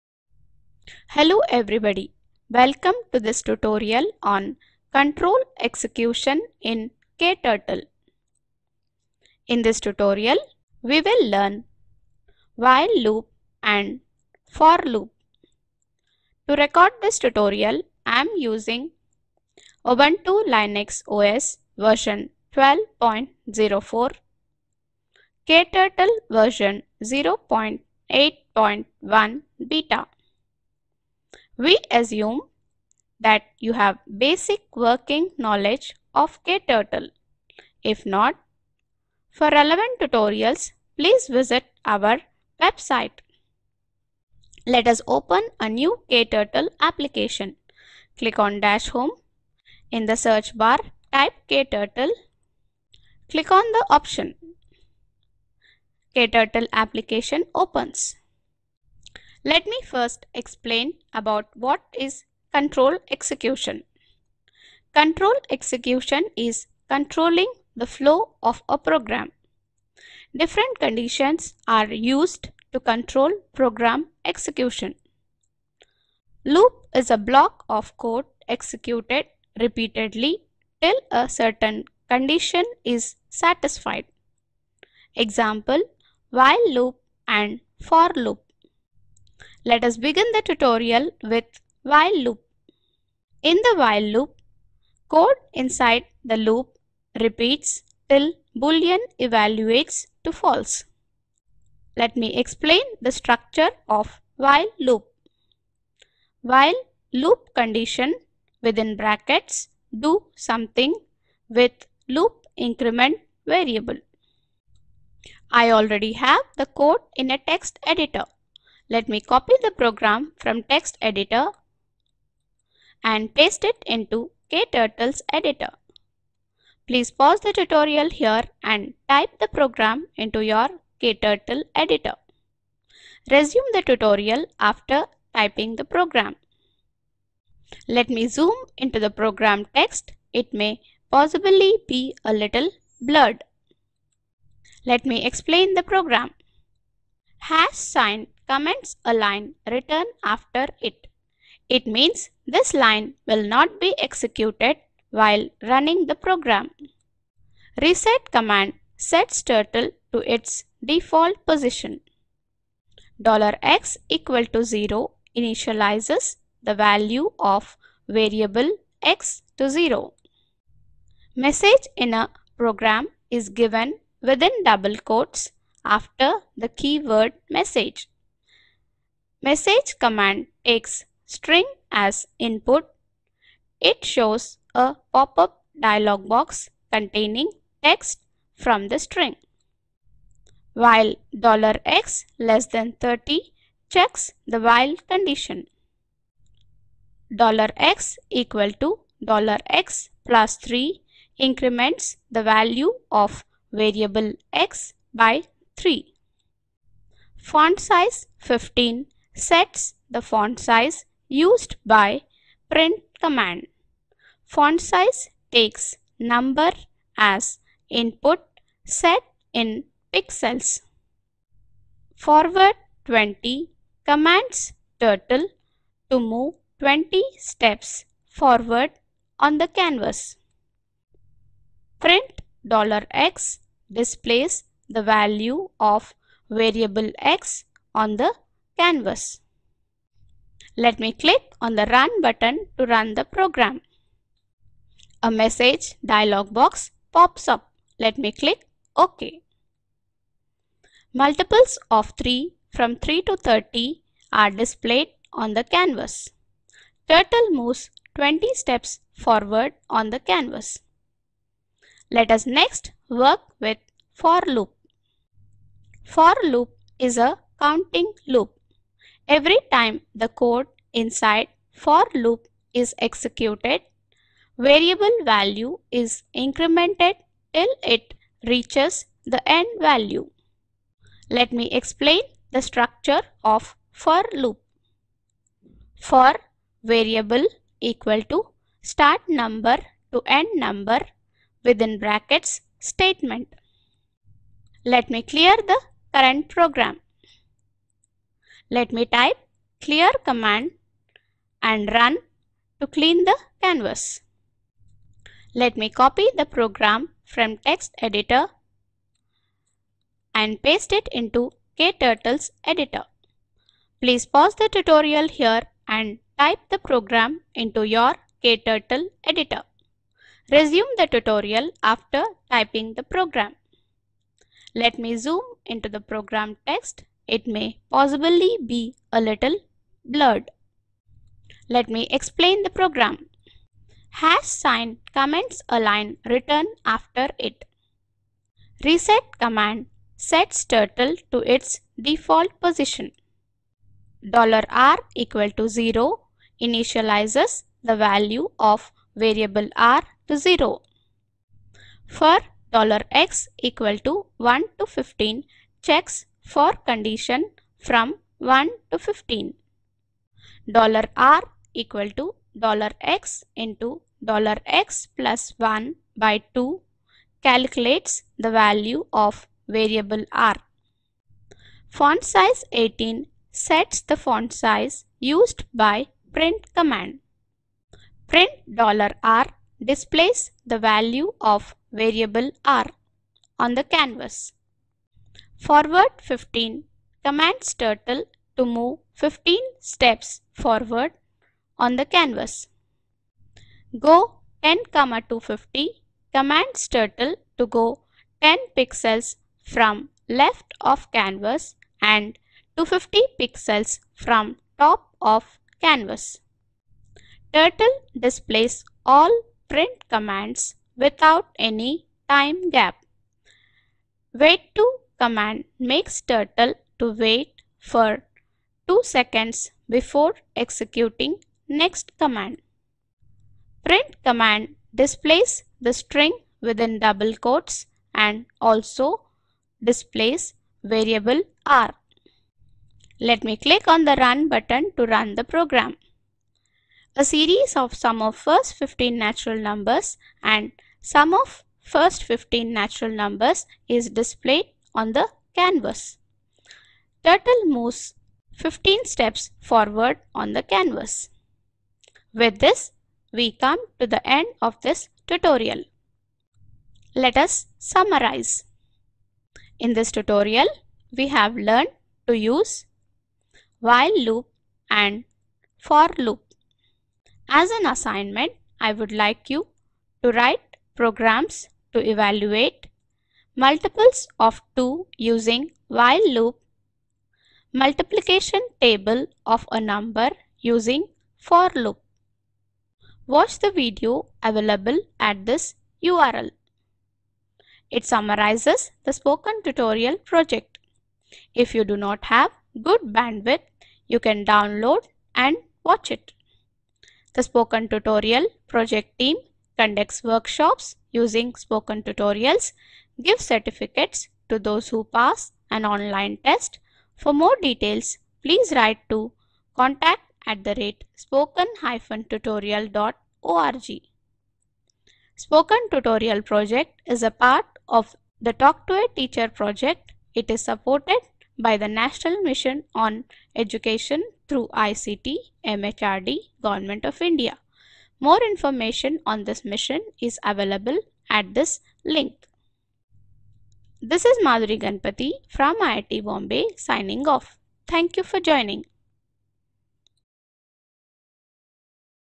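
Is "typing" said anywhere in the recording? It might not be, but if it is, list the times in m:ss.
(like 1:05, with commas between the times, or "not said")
2:15, 5:22.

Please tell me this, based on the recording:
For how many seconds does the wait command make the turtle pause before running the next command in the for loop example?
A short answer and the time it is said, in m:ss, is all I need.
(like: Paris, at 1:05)
2, at 6:58.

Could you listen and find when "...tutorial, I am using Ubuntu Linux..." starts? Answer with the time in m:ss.
0:17.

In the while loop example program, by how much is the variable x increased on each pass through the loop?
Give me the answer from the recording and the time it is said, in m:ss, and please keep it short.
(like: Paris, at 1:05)
3, at 3:21.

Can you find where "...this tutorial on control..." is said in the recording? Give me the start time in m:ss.
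0:03.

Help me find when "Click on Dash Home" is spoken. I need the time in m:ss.
0:48.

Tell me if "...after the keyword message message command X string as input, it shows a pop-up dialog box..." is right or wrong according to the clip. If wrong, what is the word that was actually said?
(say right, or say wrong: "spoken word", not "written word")
right.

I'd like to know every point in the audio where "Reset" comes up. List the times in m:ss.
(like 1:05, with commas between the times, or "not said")
2:37, 5:38.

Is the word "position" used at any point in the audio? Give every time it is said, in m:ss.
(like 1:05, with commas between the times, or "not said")
2:41, 5:42.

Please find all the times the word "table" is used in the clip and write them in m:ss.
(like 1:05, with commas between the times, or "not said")
7:58.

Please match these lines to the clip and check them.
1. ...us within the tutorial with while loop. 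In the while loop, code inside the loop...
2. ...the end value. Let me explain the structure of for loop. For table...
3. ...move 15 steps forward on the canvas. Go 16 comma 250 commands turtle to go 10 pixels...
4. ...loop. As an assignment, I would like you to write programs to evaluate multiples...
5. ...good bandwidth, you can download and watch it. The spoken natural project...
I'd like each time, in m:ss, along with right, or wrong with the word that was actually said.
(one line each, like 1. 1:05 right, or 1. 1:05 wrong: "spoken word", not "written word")
1. 1:29 wrong: "begin", not "within"
2. 4:39 wrong: "variable", not "table"
3. 6:28 wrong: "10", not "16"
4. 7:46 right
5. 8:12 wrong: "tutorial", not "natural".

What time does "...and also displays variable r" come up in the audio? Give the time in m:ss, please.
7:08.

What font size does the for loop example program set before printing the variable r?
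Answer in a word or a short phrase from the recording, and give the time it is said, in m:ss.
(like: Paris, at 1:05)
18, at 6:11.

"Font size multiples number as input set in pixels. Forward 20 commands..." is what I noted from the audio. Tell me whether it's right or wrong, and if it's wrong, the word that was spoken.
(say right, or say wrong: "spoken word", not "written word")
wrong: "takes", not "multiples".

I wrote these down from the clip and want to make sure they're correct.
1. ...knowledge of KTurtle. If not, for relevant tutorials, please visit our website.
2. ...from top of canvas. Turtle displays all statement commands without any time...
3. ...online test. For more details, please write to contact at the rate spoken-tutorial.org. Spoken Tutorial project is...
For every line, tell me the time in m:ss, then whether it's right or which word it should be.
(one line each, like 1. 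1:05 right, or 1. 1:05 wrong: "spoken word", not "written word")
1. 0:35 right
2. 6:44 wrong: "print", not "statement"
3. 8:25 right.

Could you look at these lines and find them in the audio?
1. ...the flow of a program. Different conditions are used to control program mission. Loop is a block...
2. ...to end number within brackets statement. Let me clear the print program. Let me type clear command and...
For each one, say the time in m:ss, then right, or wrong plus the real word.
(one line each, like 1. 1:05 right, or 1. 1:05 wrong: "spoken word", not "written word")
1. 1:07 wrong: "execution", not "mission"
2. 4:50 wrong: "current", not "print".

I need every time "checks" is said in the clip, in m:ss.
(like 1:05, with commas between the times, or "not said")
3:13, 5:55.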